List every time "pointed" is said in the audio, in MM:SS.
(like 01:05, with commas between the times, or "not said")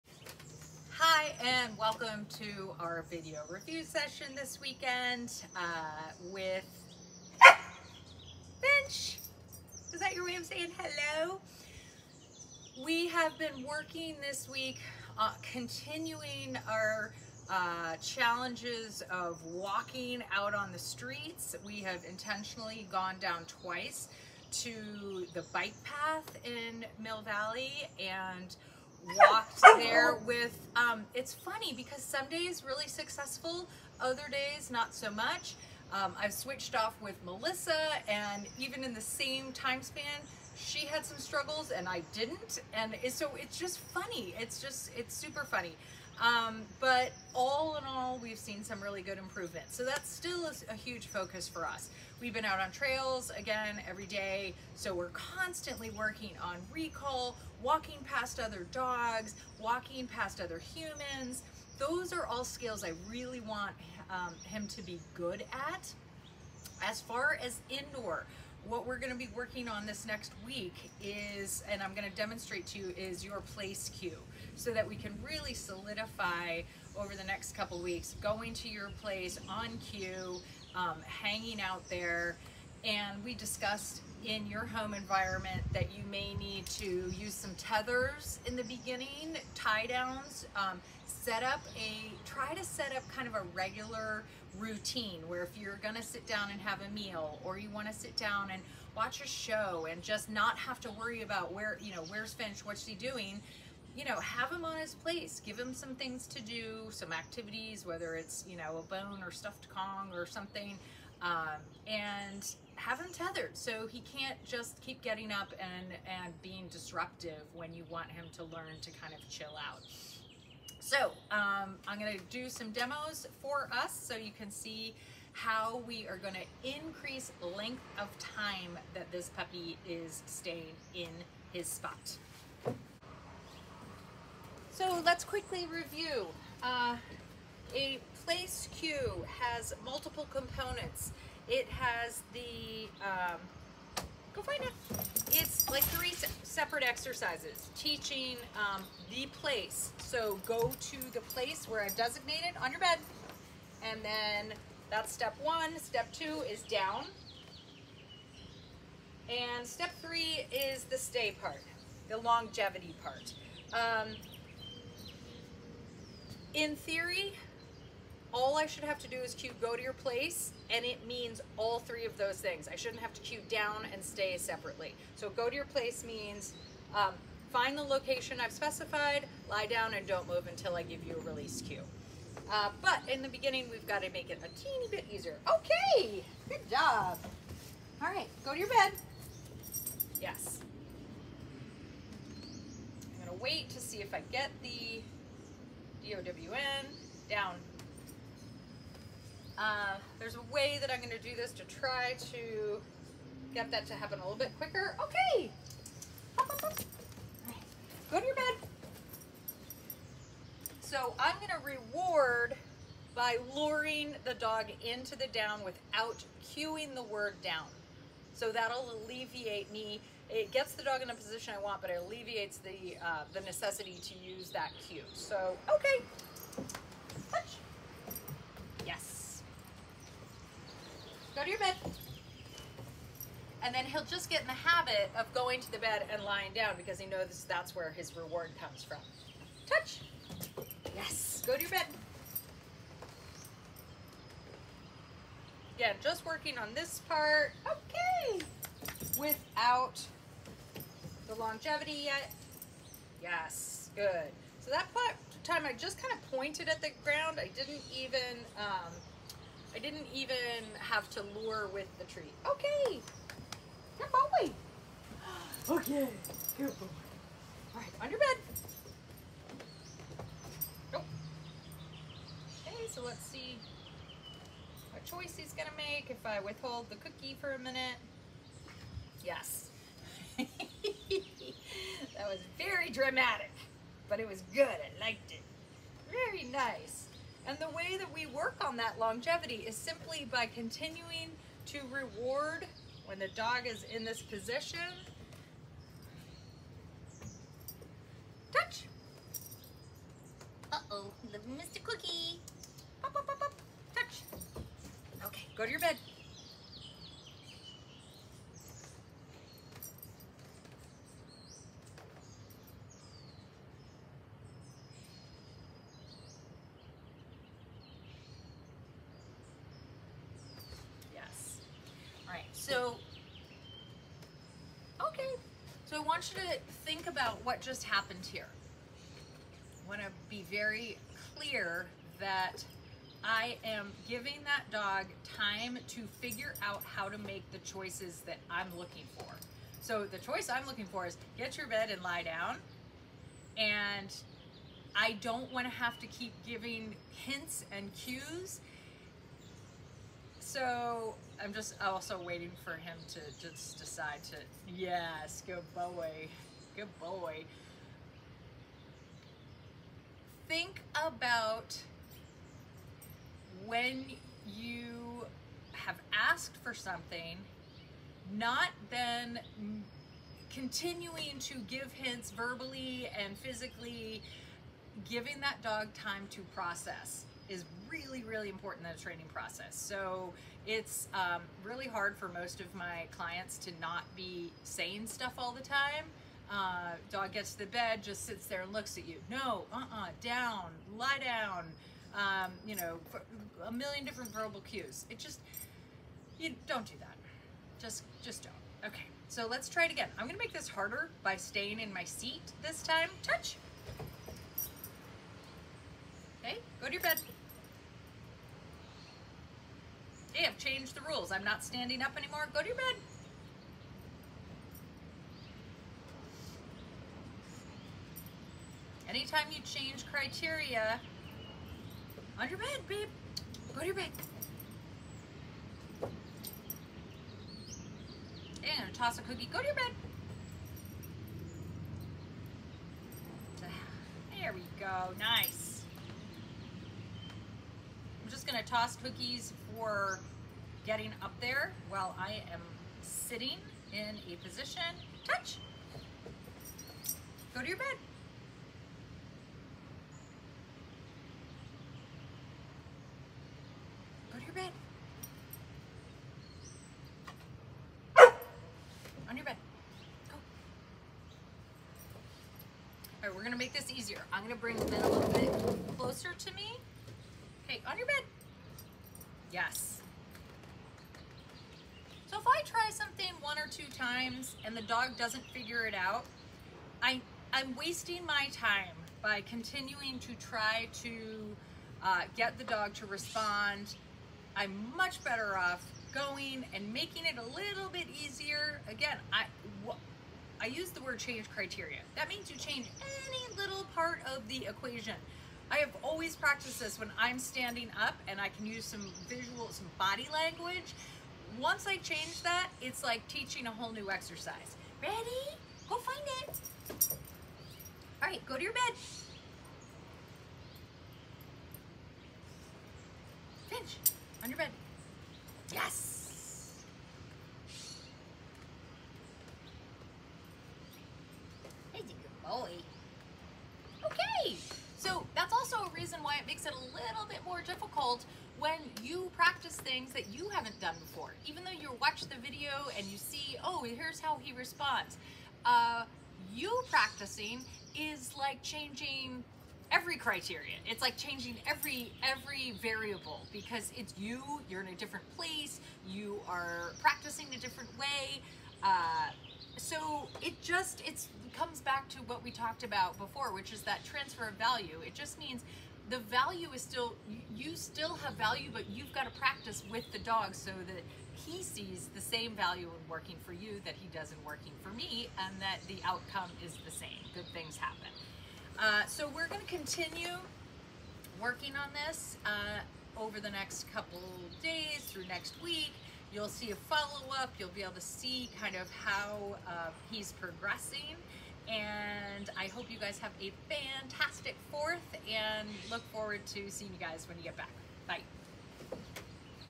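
04:16.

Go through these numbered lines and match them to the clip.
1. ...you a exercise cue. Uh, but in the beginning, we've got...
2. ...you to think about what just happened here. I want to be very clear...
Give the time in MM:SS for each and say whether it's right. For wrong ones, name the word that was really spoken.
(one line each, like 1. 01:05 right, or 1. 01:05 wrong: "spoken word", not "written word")
1. 03:01 wrong: "release", not "exercise"
2. 05:26 right.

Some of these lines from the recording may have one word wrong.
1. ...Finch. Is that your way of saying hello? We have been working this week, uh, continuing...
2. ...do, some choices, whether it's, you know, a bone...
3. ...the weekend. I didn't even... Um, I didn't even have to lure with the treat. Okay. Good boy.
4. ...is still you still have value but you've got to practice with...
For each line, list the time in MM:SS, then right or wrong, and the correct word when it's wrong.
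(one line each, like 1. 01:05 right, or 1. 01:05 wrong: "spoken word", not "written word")
1. 00:08 right
2. 01:46 wrong: "activities", not "choices"
3. 04:16 wrong: "ground", not "weekend"
4. 09:16 right.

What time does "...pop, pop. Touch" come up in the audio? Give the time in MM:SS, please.
05:03.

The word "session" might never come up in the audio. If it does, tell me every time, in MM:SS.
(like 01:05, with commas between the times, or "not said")
00:03.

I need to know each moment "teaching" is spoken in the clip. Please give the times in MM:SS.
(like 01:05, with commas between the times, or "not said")
02:27, 08:23.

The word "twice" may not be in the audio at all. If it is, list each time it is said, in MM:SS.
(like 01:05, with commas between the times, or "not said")
00:23.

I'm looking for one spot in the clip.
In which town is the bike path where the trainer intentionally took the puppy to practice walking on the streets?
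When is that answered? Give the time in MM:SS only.
00:27.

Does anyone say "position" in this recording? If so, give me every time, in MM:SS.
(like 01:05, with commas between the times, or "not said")
03:41, 04:54, 07:24.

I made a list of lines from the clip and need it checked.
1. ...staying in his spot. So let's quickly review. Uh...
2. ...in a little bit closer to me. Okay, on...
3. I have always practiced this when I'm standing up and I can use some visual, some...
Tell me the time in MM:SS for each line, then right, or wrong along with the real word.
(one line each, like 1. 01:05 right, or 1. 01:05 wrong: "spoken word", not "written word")
1. 02:10 right
2. 07:44 right
3. 08:15 right.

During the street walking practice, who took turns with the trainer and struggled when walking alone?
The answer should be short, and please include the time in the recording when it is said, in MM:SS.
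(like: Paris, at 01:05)
Melissa, at 00:37.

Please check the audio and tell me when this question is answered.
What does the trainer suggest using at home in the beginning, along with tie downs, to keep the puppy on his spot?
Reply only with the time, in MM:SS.
01:27.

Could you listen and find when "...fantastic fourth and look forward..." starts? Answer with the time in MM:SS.
09:43.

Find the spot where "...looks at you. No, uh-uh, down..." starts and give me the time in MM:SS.
06:28.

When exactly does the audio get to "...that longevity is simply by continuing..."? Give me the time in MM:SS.
04:48.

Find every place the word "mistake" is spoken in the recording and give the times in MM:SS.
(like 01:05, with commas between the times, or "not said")
not said.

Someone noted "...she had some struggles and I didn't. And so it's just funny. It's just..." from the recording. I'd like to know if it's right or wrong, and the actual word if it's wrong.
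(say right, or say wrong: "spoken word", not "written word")
right.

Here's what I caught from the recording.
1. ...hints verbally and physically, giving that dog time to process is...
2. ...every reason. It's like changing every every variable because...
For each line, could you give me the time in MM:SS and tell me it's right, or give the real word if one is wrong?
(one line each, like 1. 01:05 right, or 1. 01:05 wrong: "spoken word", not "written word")
1. 06:11 right
2. 08:59 wrong: "criterion", not "reason".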